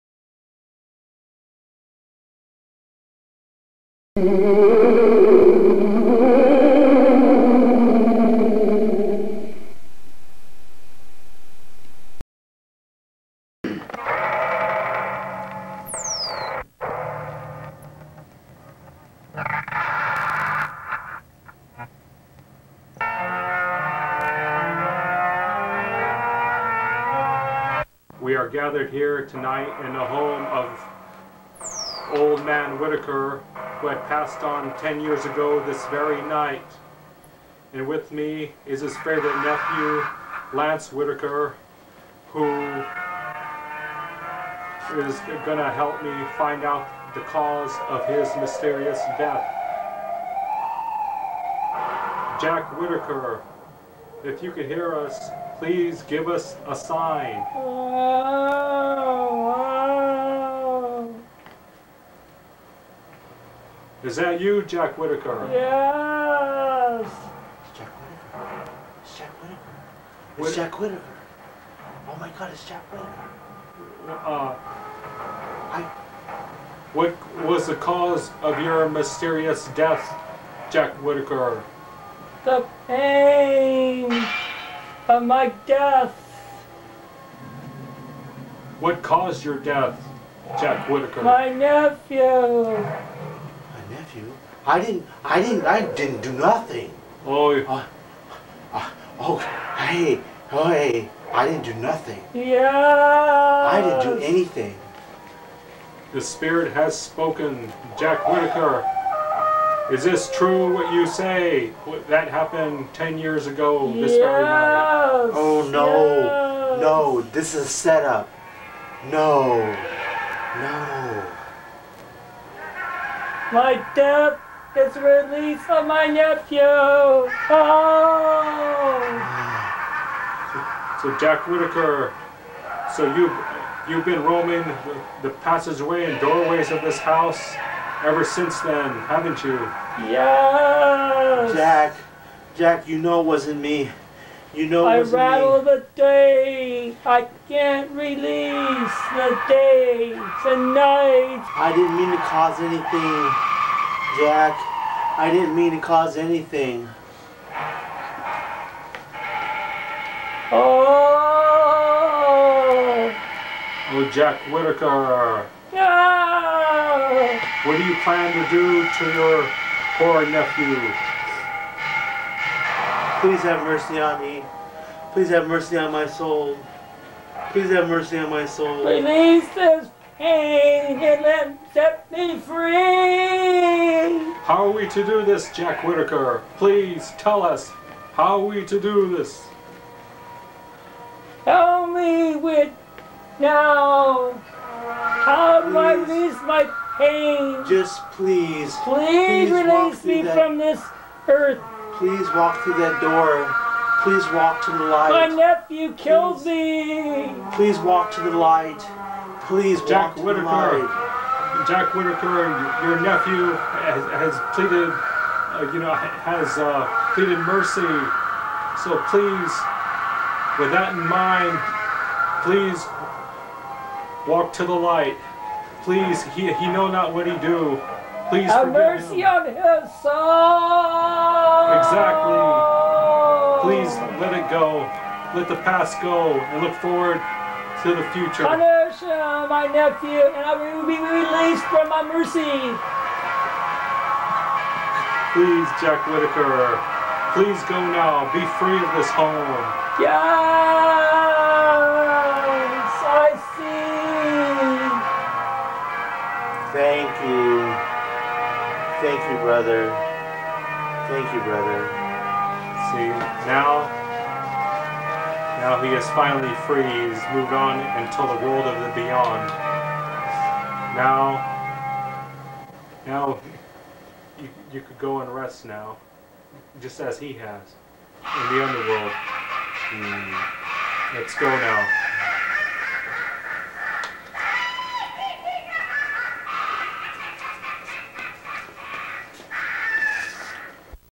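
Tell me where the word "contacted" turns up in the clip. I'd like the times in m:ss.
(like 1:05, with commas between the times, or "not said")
not said.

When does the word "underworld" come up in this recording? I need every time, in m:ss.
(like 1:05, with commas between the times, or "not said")
4:38.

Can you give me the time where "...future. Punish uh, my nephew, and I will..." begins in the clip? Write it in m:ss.
3:58.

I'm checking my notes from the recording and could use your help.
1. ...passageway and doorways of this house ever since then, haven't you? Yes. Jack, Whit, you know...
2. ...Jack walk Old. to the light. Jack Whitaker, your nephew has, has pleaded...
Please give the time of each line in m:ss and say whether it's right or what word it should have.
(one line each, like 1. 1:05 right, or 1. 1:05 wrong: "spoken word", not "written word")
1. 2:15 wrong: "Jack", not "Whit"
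2. 3:29 wrong: "Whitaker", not "Old".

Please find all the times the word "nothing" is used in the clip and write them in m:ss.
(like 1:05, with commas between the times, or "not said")
1:36, 1:41.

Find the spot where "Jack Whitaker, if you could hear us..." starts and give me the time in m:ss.
0:52.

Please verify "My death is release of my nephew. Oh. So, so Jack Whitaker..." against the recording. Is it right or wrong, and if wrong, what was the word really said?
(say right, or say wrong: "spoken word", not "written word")
right.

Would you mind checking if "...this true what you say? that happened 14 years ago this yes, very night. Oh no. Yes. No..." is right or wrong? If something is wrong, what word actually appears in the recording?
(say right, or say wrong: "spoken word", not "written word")
wrong: "10", not "14".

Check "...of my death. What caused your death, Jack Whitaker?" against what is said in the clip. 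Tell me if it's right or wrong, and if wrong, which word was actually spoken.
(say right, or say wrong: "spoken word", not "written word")
right.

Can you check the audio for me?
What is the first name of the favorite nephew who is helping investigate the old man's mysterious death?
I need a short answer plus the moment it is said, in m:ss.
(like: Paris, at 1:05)
Lance, at 0:40.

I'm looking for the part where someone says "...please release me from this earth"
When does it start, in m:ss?
3:18.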